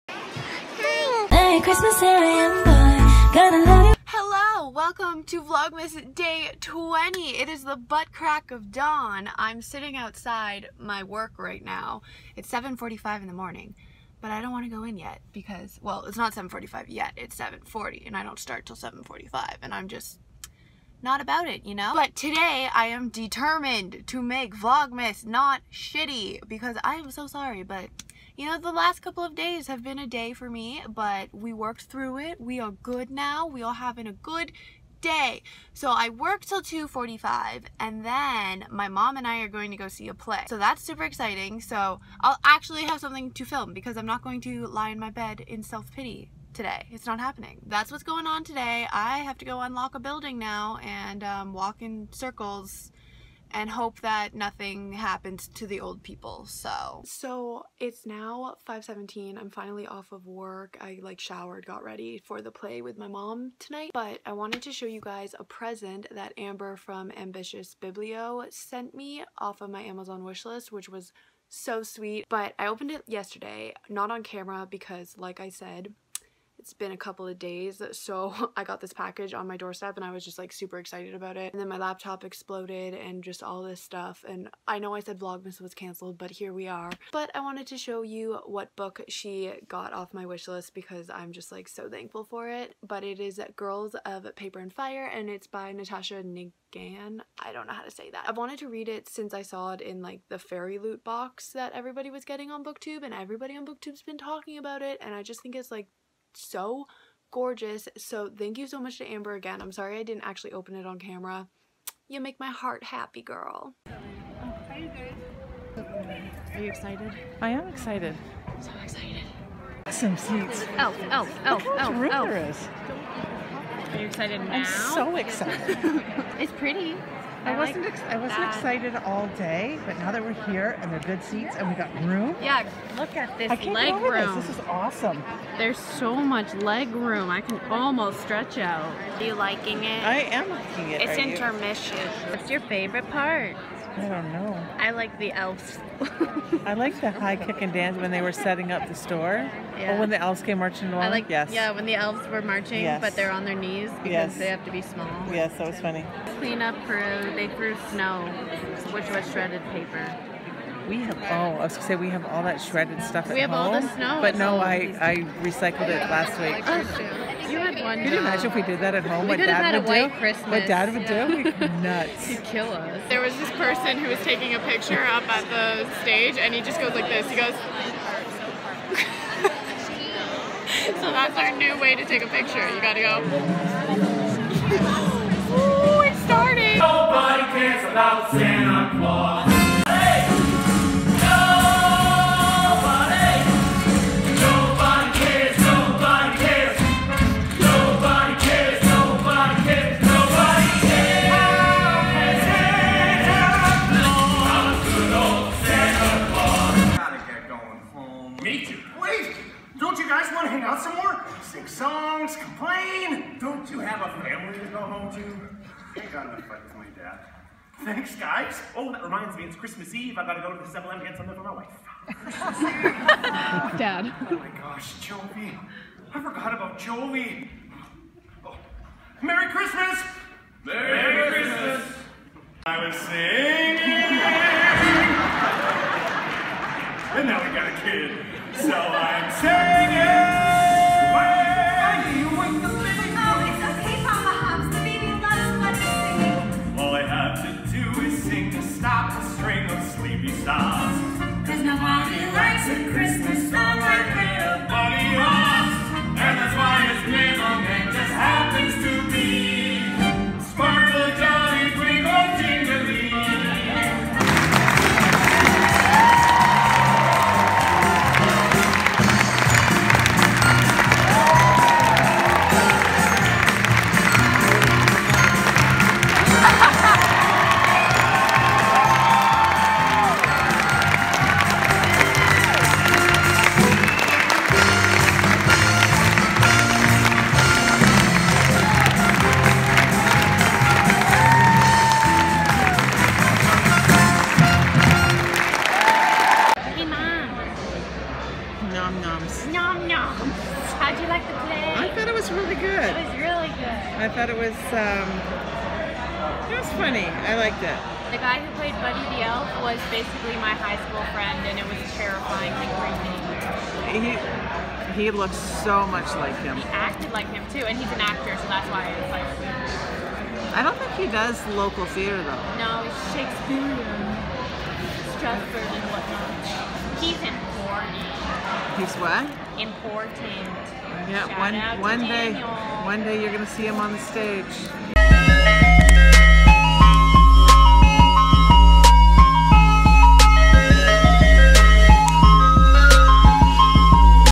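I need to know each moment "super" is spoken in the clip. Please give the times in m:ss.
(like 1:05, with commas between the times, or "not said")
0:40, 1:20.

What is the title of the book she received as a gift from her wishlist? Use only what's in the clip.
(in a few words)
Girls of Paper and Fire.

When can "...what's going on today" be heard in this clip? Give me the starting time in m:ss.
0:47.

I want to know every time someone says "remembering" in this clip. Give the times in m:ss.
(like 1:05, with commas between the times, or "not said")
not said.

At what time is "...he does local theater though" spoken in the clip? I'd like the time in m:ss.
5:20.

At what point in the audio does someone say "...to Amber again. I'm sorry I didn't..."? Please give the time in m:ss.
1:48.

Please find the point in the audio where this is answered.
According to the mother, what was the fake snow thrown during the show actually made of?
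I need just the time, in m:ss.
2:39.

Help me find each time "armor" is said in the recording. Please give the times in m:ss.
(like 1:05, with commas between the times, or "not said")
not said.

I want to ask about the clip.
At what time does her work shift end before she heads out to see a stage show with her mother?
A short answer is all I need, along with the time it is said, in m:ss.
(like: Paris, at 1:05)
2:45, at 0:36.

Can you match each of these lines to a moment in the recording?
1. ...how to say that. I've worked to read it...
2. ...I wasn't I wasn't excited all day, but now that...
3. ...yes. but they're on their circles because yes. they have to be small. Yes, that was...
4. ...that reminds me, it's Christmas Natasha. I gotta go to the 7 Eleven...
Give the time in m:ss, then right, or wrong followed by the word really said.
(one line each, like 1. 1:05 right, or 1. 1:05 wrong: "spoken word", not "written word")
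1. 1:37 wrong: "wanted", not "worked"
2. 2:07 right
3. 2:32 wrong: "knees", not "circles"
4. 3:38 wrong: "Eve", not "Natasha".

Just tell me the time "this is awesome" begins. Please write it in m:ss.
2:14.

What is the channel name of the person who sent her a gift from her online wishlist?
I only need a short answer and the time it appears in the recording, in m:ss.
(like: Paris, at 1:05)
Ambitious Biblio, at 1:07.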